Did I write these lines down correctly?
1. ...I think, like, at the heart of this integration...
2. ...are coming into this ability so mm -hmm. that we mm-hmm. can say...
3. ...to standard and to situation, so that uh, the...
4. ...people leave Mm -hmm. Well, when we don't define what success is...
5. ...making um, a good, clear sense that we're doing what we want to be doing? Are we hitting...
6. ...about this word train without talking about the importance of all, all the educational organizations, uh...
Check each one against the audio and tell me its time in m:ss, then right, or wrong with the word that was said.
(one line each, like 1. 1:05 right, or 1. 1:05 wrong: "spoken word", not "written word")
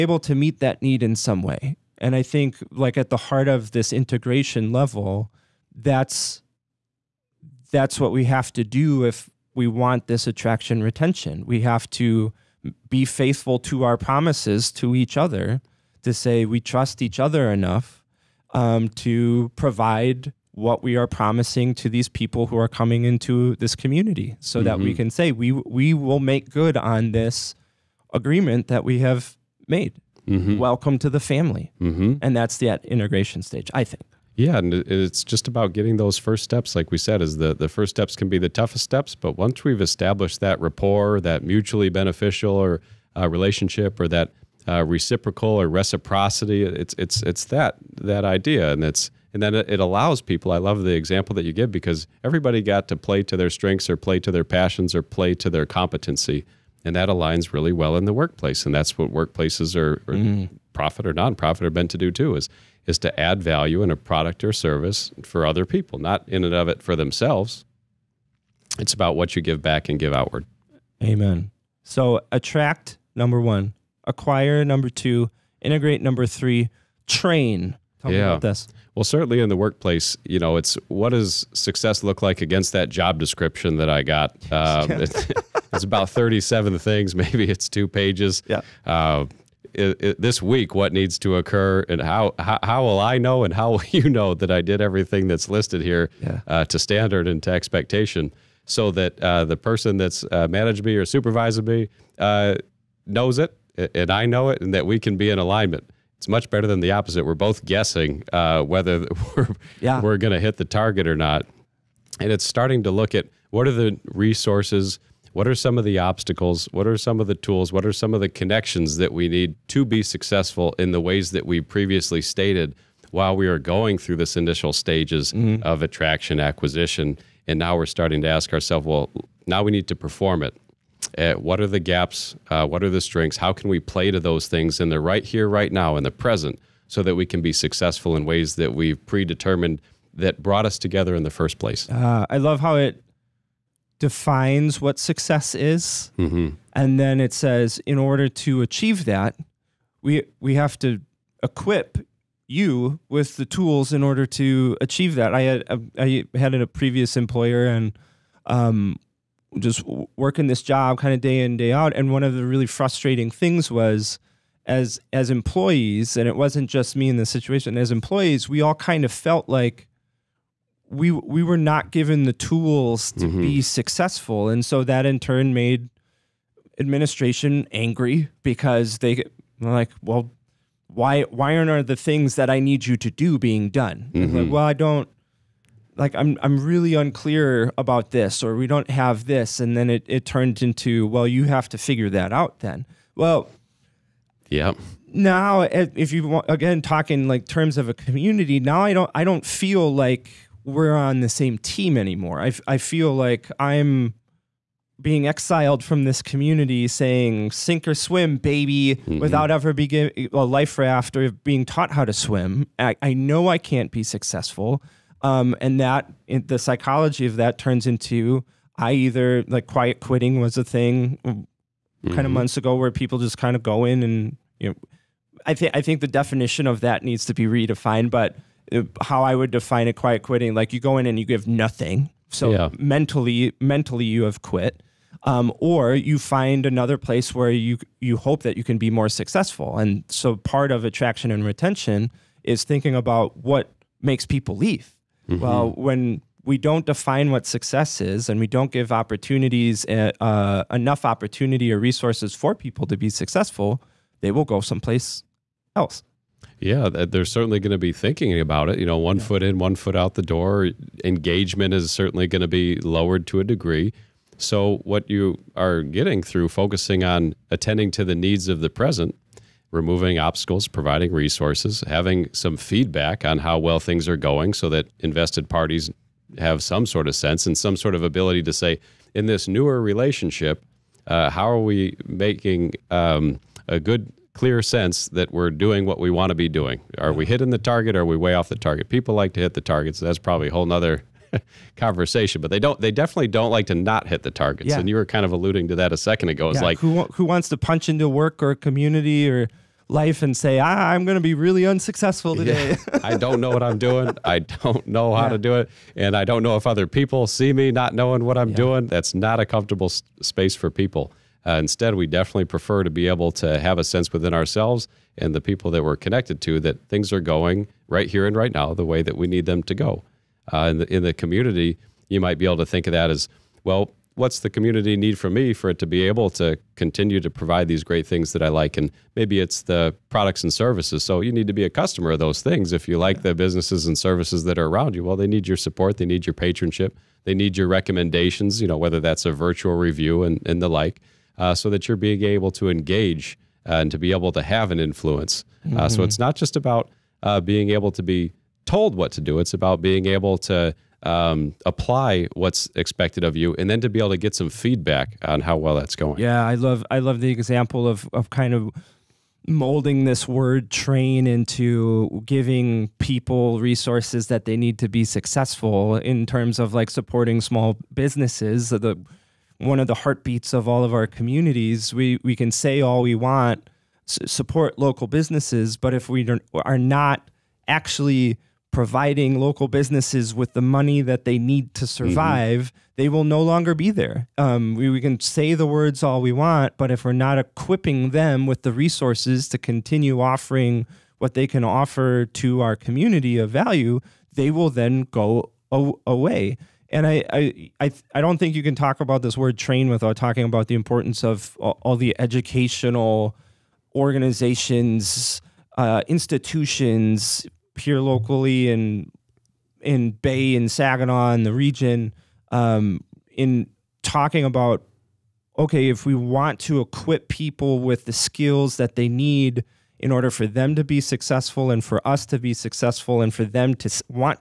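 1. 0:02 right
2. 0:22 wrong: "community", not "ability"
3. 1:36 wrong: "expectation", not "situation"
4. 4:04 right
5. 4:42 right
6. 6:38 right.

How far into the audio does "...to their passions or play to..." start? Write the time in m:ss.
0:54.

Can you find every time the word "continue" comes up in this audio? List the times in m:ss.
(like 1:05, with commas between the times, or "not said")
5:26, 6:29.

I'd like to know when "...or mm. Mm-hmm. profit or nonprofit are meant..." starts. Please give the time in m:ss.
1:00.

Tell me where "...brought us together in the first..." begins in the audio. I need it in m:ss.
2:20.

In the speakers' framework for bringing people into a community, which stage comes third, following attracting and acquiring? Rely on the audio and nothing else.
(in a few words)
Integrate.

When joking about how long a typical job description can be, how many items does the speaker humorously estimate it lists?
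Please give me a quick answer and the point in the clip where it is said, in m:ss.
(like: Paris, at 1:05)
37, at 1:26.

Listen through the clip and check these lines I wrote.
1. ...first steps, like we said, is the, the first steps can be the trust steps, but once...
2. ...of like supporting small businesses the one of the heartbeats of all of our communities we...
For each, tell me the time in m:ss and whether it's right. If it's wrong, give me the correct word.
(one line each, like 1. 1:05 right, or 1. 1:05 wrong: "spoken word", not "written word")
1. 0:36 wrong: "toughest", not "trust"
2. 6:06 right.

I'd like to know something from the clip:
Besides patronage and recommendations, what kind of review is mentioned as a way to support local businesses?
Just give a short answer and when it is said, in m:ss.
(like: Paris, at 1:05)
A virtual review, at 5:39.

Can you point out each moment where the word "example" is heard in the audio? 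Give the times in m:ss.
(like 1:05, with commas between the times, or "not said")
0:50, 5:57.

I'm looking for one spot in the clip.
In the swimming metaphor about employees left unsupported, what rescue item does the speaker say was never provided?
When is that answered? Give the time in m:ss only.
3:30.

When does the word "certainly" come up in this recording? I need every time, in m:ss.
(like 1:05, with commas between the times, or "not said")
1:19, 4:17, 4:21.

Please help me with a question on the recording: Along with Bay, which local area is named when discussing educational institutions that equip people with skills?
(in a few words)
Saginaw.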